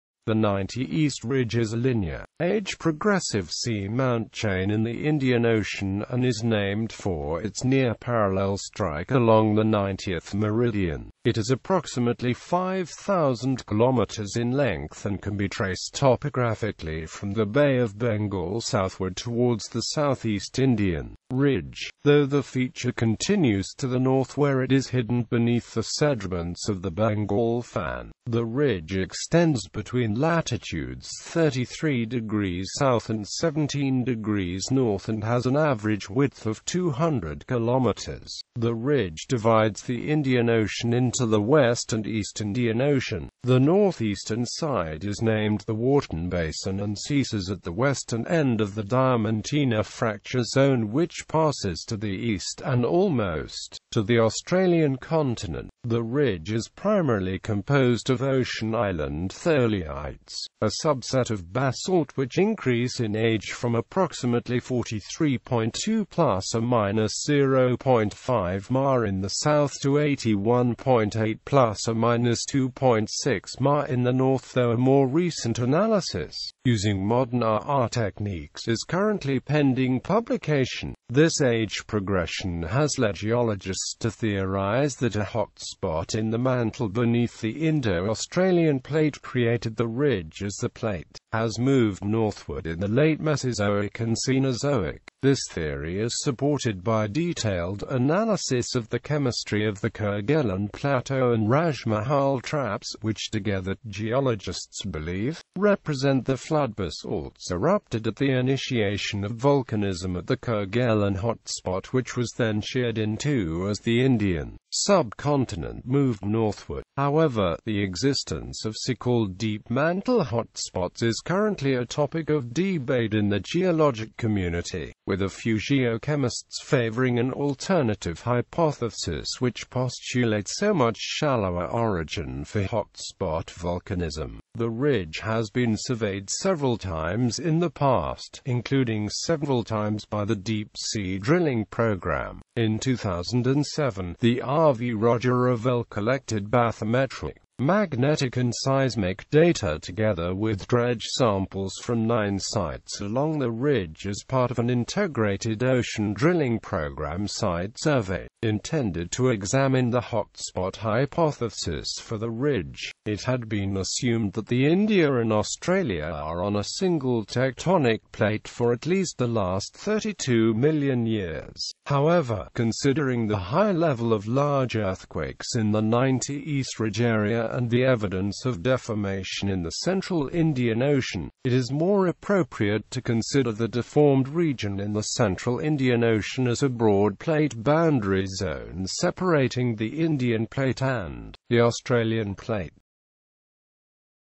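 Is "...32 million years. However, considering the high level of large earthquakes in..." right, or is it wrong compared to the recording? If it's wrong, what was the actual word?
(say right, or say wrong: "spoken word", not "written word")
right.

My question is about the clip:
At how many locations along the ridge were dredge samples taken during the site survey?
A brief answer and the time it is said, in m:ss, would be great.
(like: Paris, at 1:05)
9, at 2:32.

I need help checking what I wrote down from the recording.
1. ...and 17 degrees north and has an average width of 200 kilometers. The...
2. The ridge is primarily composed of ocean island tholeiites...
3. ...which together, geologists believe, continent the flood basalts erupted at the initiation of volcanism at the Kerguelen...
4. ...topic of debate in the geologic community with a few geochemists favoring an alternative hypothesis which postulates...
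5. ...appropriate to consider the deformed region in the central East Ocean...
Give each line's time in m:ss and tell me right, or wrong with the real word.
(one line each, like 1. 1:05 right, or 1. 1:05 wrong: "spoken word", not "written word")
1. 0:33 right
2. 0:55 right
3. 1:43 wrong: "represent", not "continent"
4. 2:01 right
5. 3:02 wrong: "Indian", not "East".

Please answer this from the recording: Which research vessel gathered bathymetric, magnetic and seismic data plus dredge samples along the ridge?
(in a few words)
RV Roger Revelle.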